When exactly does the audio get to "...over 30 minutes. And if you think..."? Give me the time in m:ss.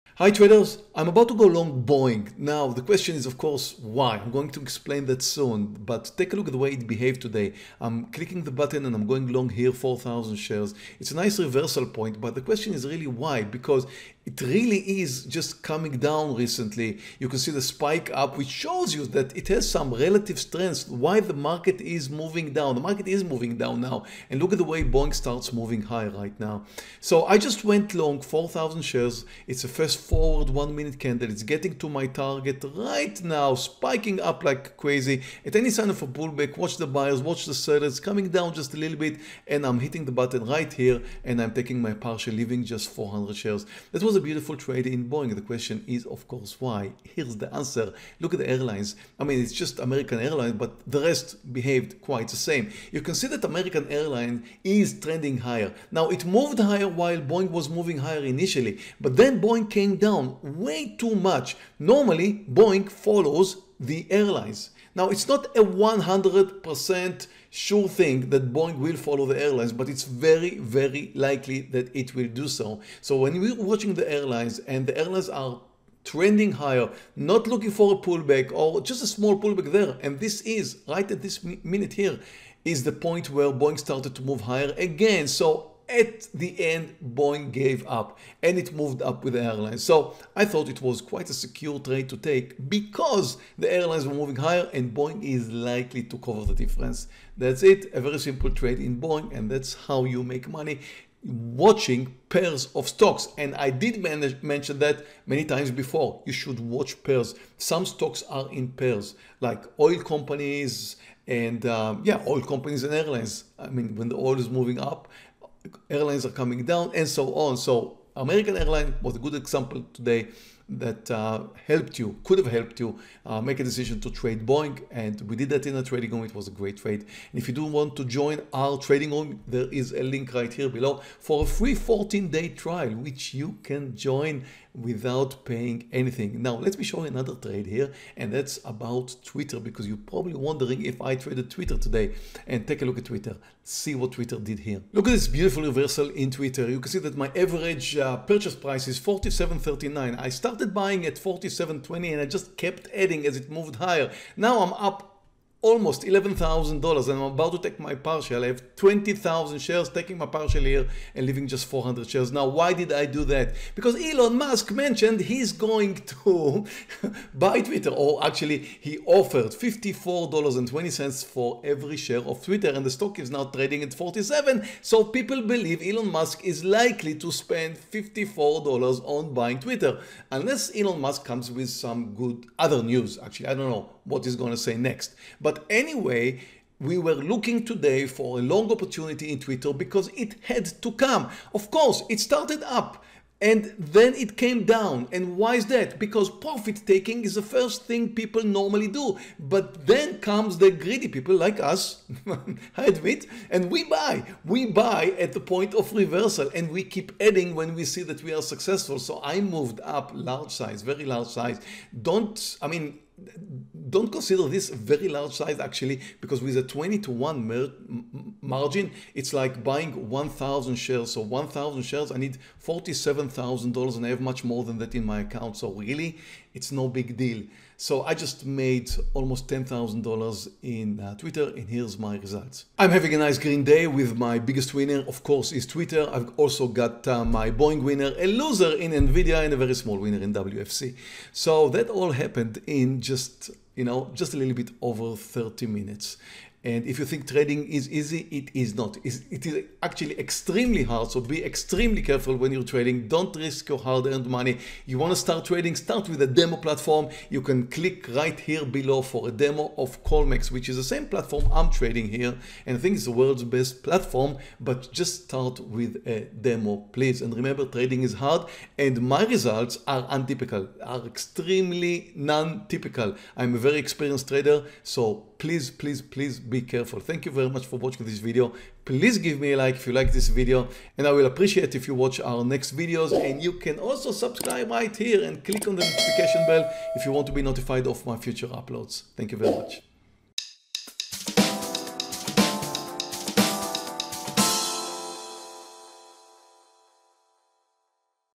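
4:04.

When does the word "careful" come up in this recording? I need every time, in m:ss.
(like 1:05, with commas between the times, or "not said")
4:12, 4:36.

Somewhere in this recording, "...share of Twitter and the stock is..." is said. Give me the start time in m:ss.
2:51.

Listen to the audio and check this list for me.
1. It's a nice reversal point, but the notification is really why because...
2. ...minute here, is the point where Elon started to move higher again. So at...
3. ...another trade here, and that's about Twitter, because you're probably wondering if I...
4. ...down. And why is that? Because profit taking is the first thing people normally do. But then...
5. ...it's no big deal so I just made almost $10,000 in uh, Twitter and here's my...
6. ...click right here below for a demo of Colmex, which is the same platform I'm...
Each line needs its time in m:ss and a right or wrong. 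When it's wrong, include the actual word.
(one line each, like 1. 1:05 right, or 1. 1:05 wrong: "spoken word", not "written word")
1. 0:10 wrong: "question", not "notification"
2. 1:21 wrong: "Boeing", not "Elon"
3. 2:17 right
4. 3:14 right
5. 3:46 right
6. 4:17 right.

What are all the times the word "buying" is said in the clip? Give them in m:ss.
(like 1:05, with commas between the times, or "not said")
2:30, 2:59, 3:39.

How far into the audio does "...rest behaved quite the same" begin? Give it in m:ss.
0:50.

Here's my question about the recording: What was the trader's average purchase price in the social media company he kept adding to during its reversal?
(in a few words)
47.39.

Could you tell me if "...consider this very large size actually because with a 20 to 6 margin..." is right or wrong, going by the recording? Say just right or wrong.
wrong.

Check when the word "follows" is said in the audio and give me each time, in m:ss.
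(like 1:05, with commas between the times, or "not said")
1:03, 1:08.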